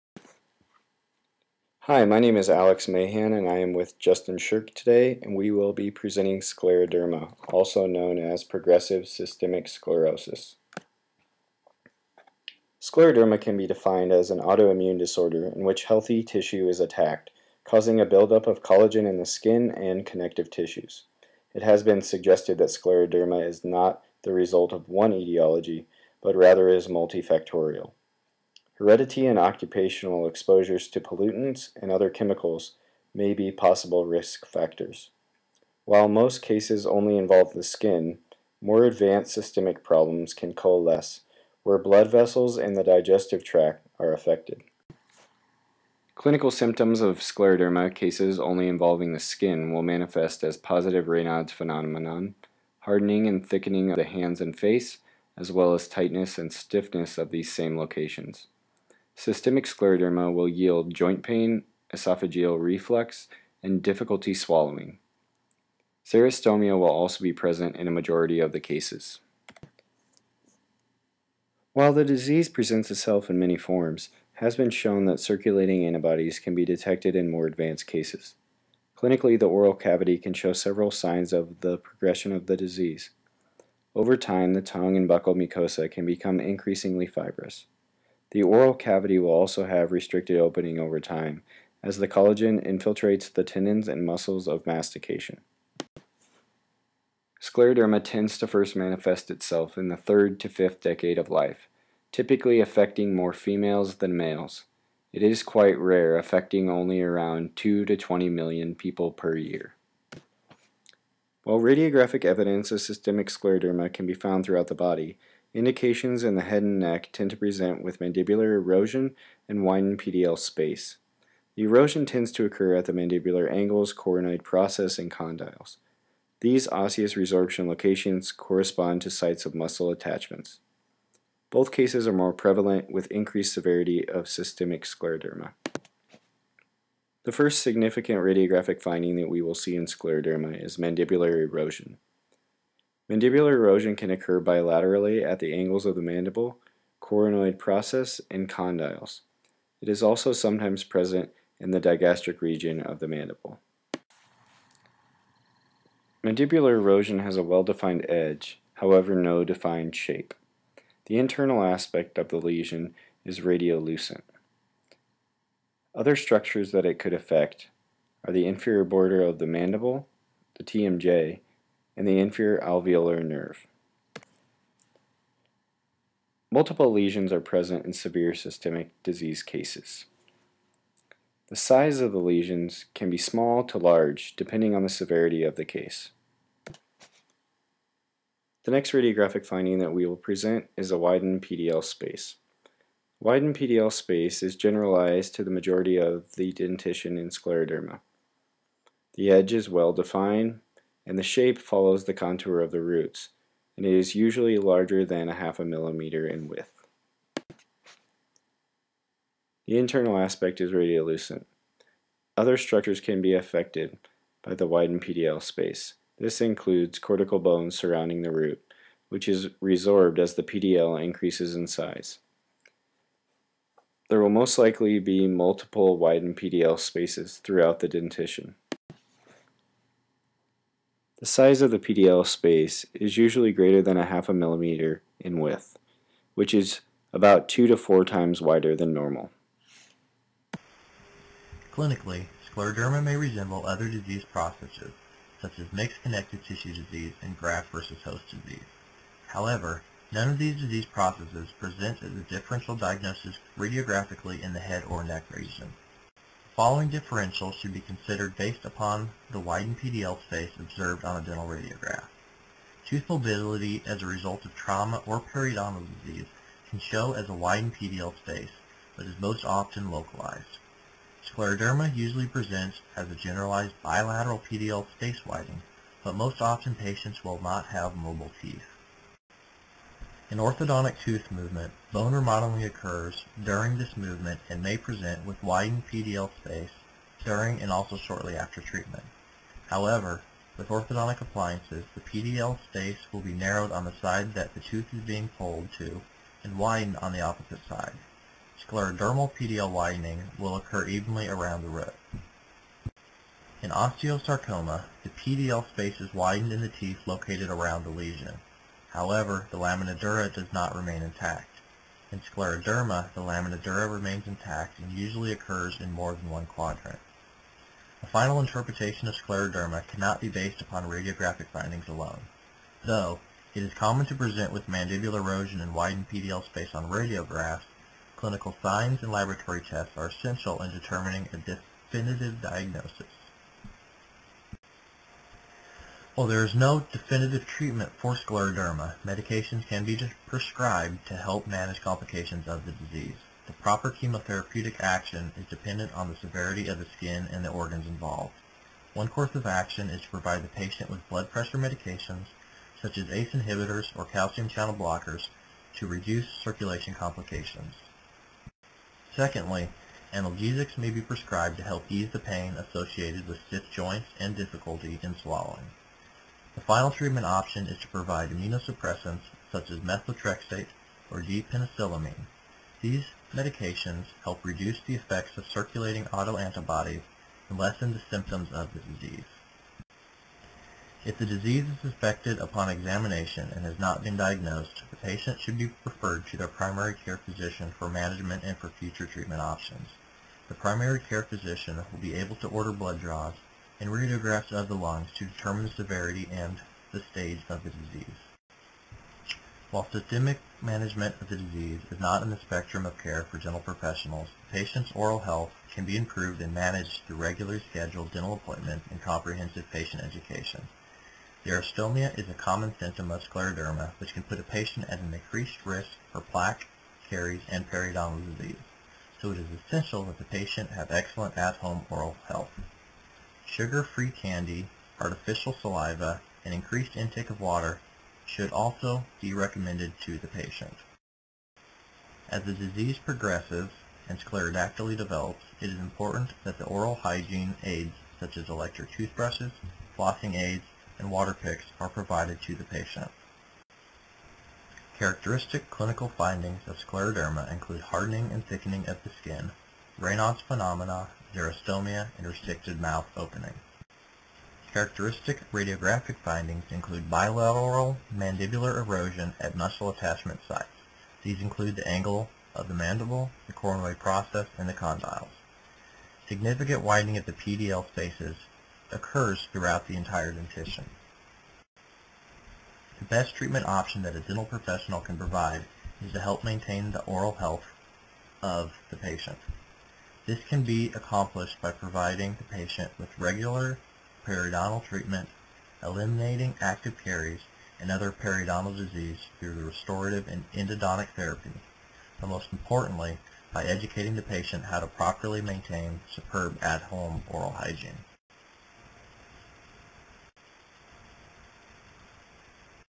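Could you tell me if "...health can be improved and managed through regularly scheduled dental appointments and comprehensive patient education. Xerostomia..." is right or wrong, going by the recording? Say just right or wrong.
right.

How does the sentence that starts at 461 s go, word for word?
These include the angle of the mandible, the coronoid process, and the condyles.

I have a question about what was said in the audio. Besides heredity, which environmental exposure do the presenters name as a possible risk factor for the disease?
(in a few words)
pollutants.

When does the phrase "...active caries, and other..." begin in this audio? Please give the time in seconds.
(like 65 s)
486 s.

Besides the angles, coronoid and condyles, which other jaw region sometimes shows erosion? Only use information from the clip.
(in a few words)
digastric region.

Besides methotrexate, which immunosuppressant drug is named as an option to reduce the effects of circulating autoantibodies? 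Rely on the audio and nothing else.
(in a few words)
D-penicillamine.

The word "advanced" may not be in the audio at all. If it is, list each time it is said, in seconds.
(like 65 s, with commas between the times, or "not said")
38 s, 77 s.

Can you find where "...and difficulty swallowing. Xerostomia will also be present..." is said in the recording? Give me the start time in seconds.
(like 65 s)
63 s.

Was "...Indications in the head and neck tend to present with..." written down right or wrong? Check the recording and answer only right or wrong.
right.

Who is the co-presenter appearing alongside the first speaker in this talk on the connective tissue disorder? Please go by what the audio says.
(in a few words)
Justin Shirk.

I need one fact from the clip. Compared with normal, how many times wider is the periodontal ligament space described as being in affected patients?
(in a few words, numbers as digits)
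2 to 4 times.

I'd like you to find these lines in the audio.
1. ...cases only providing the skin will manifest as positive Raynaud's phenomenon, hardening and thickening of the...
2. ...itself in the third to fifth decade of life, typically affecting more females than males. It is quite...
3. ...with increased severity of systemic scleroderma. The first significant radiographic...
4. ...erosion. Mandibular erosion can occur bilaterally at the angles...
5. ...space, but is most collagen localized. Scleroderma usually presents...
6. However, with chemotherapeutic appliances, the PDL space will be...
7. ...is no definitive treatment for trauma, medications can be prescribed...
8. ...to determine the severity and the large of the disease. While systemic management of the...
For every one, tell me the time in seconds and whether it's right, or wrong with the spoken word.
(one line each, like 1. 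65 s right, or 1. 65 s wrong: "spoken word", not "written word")
1. 47 s wrong: "involving", not "providing"
2. 99 s right
3. 132 s right
4. 141 s right
5. 268 s wrong: "often", not "collagen"
6. 289 s wrong: "orthodontic", not "chemotherapeutic"
7. 336 s wrong: "scleroderma", not "trauma"
8. 395 s wrong: "stage", not "large".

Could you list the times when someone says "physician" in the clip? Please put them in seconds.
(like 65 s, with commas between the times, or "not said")
387 s, 391 s.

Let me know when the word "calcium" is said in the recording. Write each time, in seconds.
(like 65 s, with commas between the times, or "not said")
354 s.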